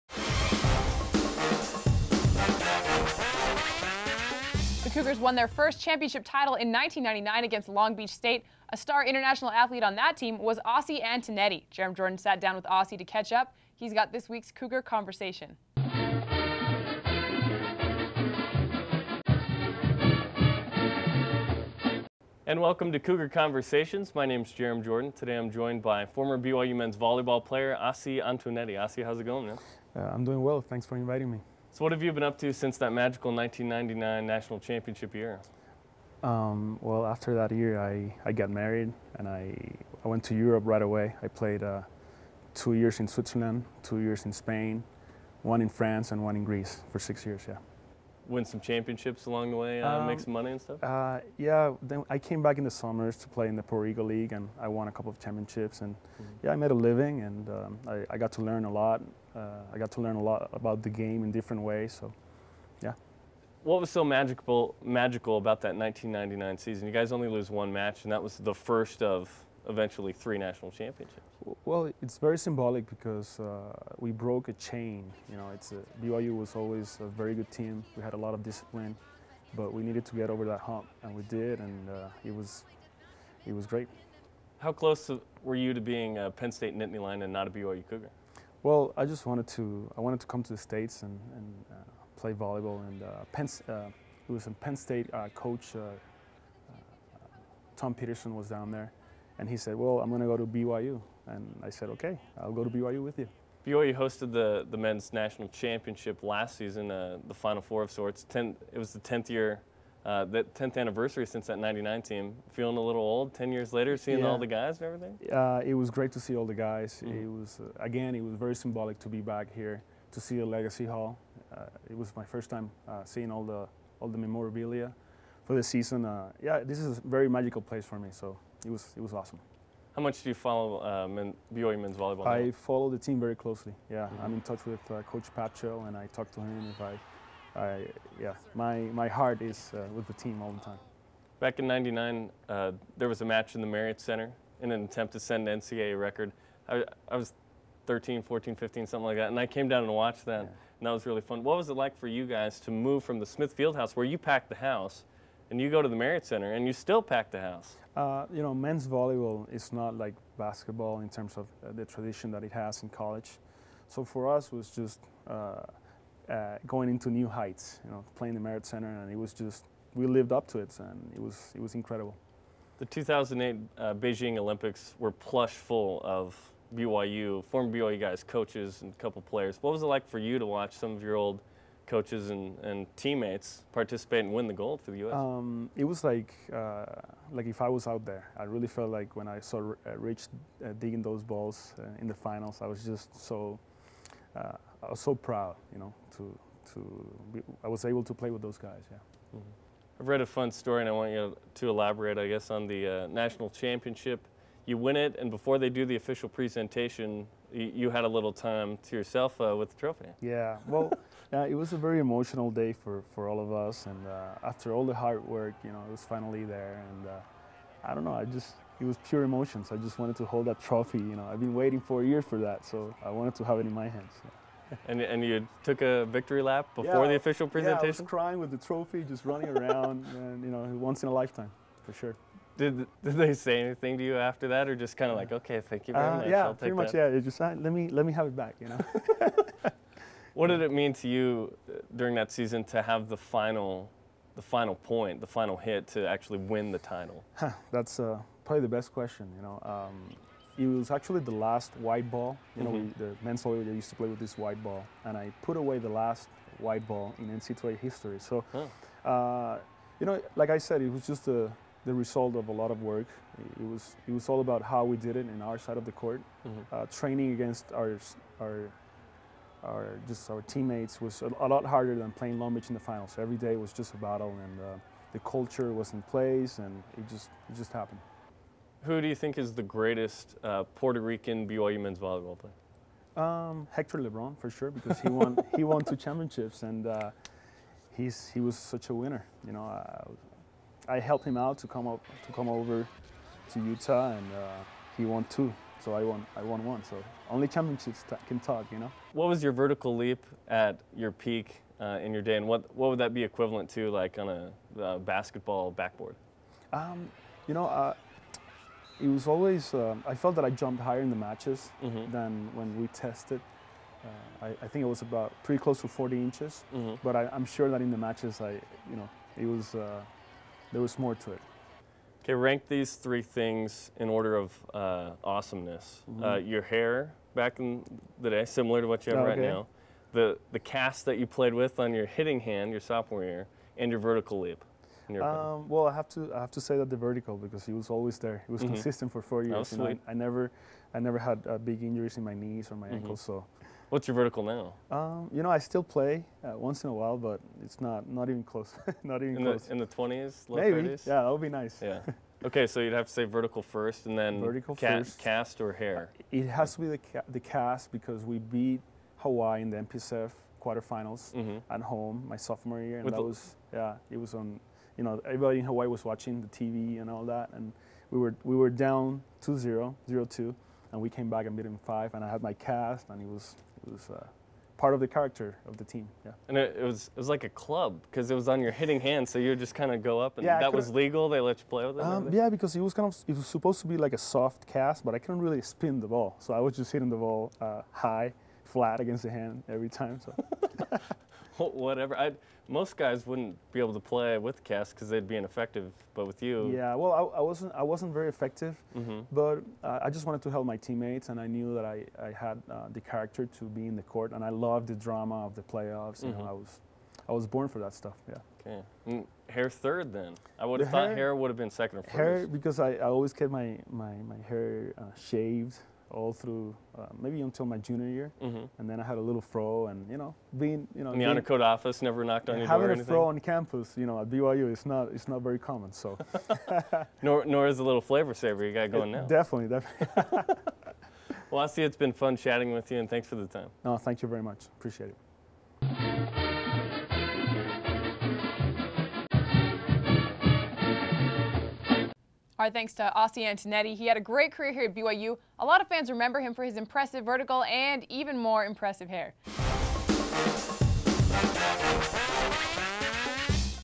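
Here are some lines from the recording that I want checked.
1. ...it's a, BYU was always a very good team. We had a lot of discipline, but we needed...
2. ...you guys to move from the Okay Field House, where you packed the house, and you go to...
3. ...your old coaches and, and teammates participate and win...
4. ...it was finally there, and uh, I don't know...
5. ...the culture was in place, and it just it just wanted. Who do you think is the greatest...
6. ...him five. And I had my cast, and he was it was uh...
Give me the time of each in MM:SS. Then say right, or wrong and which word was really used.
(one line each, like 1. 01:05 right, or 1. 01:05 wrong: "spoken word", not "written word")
1. 01:15 right
2. 02:32 wrong: "Smith", not "Okay"
3. 03:01 right
4. 03:35 right
5. 04:35 wrong: "happened", not "wanted"
6. 06:11 right.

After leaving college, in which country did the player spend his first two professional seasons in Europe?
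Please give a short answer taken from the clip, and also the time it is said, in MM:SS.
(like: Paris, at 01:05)
Switzerland, at 00:43.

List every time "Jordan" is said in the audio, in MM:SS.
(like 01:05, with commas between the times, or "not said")
00:11, 00:24.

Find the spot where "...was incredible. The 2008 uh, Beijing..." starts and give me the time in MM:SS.
02:51.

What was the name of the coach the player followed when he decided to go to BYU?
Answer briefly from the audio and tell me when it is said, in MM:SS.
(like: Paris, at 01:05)
Tom Peterson, at 01:37.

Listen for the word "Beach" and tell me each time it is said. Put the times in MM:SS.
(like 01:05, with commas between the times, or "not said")
00:07, 04:32.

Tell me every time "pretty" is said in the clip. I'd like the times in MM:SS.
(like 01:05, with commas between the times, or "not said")
03:56, 05:15.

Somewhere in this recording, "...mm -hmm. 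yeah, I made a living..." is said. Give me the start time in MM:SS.
00:55.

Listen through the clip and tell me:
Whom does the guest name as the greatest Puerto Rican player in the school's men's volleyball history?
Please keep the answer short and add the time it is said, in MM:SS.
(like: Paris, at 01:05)
Hector LeBron, at 04:43.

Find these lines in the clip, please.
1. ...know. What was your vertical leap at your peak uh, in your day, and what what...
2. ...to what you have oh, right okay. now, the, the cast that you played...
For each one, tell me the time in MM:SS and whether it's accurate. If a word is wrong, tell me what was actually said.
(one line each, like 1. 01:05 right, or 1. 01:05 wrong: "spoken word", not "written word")
1. 04:58 right
2. 05:28 right.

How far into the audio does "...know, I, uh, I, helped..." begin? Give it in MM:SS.
04:49.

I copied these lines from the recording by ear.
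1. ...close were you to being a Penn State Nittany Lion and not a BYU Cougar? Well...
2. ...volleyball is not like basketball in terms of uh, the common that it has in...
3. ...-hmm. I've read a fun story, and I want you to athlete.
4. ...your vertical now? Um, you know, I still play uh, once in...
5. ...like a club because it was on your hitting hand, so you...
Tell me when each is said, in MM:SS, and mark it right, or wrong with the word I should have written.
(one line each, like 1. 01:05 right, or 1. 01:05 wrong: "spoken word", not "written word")
1. 01:24 right
2. 02:38 wrong: "tradition", not "common"
3. 03:19 wrong: "elaborate", not "athlete"
4. 05:44 right
5. 06:17 right.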